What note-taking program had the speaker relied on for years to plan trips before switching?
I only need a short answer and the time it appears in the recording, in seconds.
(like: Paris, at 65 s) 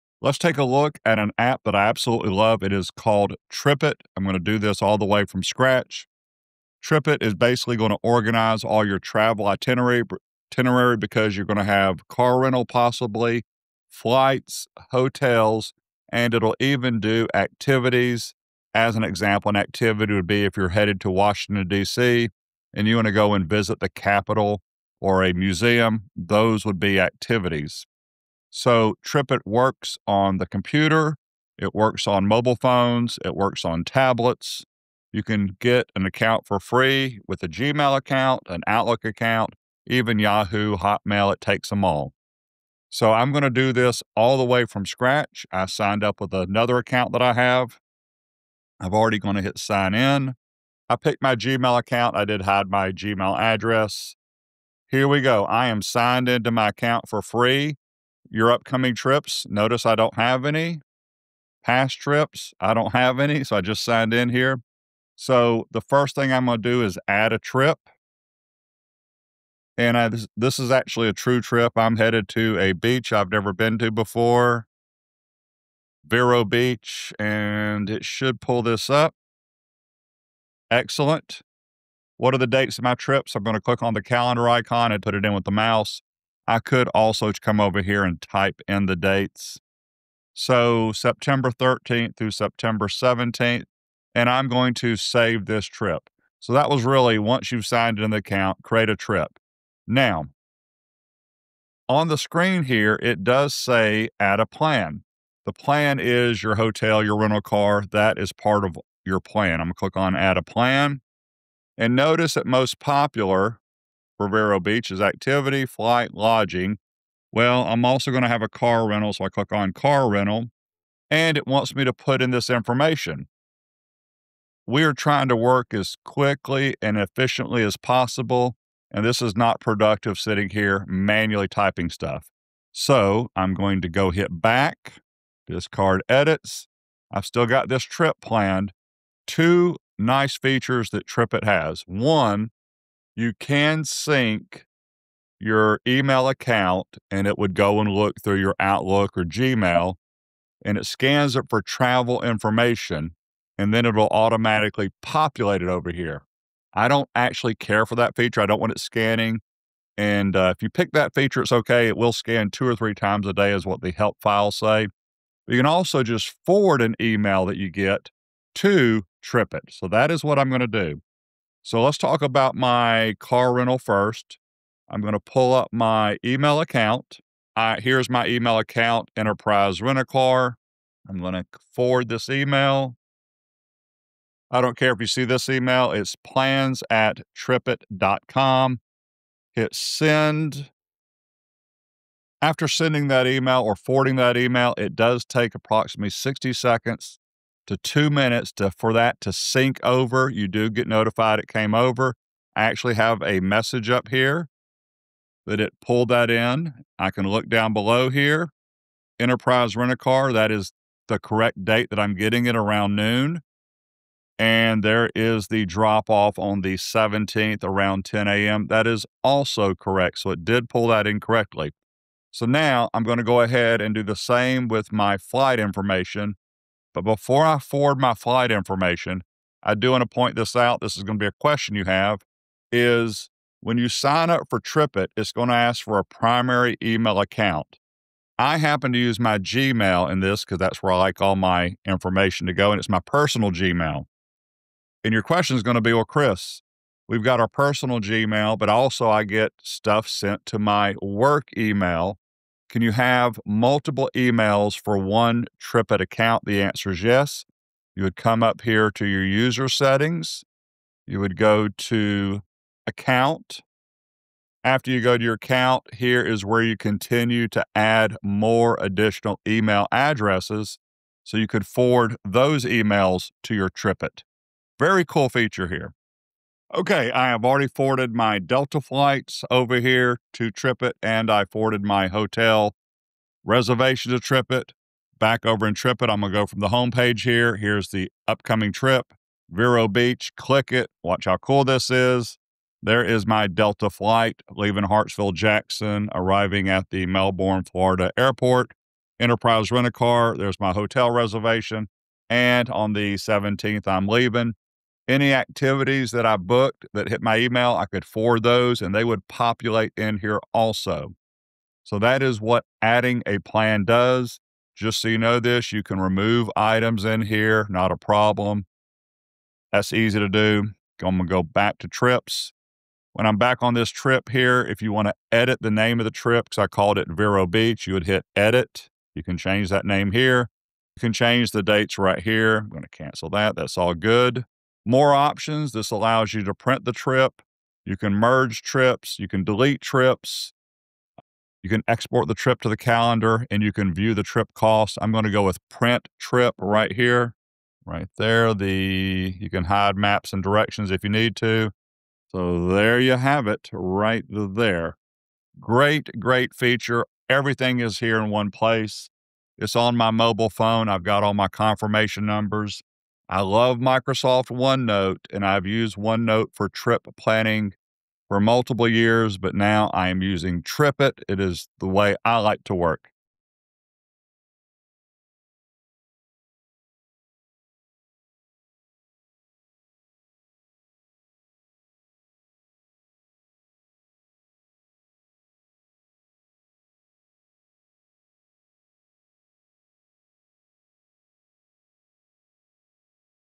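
Microsoft OneNote, at 363 s.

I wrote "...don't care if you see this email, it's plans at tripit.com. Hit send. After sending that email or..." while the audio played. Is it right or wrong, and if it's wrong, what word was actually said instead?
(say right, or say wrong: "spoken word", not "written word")
right.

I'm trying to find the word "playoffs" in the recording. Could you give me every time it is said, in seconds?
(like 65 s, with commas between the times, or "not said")
not said.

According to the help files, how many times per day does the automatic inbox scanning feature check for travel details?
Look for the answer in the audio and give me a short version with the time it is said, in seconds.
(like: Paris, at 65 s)
2 or 3, at 162 s.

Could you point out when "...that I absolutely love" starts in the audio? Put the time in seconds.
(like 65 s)
1 s.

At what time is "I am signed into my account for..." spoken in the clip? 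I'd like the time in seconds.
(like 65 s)
55 s.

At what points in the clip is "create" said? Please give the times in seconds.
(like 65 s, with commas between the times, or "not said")
98 s.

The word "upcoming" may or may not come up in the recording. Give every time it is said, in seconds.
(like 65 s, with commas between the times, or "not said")
58 s, 288 s.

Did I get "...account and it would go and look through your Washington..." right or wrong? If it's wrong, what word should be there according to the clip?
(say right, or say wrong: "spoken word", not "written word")
wrong: "Outlook", not "Washington".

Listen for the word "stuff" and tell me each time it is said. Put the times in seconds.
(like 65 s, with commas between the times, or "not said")
131 s, 249 s.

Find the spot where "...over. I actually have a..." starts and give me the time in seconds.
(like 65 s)
201 s.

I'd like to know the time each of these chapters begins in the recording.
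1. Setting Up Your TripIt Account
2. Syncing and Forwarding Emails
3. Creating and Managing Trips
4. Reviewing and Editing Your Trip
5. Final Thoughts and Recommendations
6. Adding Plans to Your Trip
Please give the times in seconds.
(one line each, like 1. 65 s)
1. 28 s
2. 141 s
3. 65 s
4. 287 s
5. 357 s
6. 105 s.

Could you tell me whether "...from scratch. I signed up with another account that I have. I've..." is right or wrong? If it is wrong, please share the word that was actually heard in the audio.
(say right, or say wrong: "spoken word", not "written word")
right.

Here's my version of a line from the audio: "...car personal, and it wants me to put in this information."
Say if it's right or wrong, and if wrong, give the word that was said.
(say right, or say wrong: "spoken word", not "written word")
wrong: "rental", not "personal".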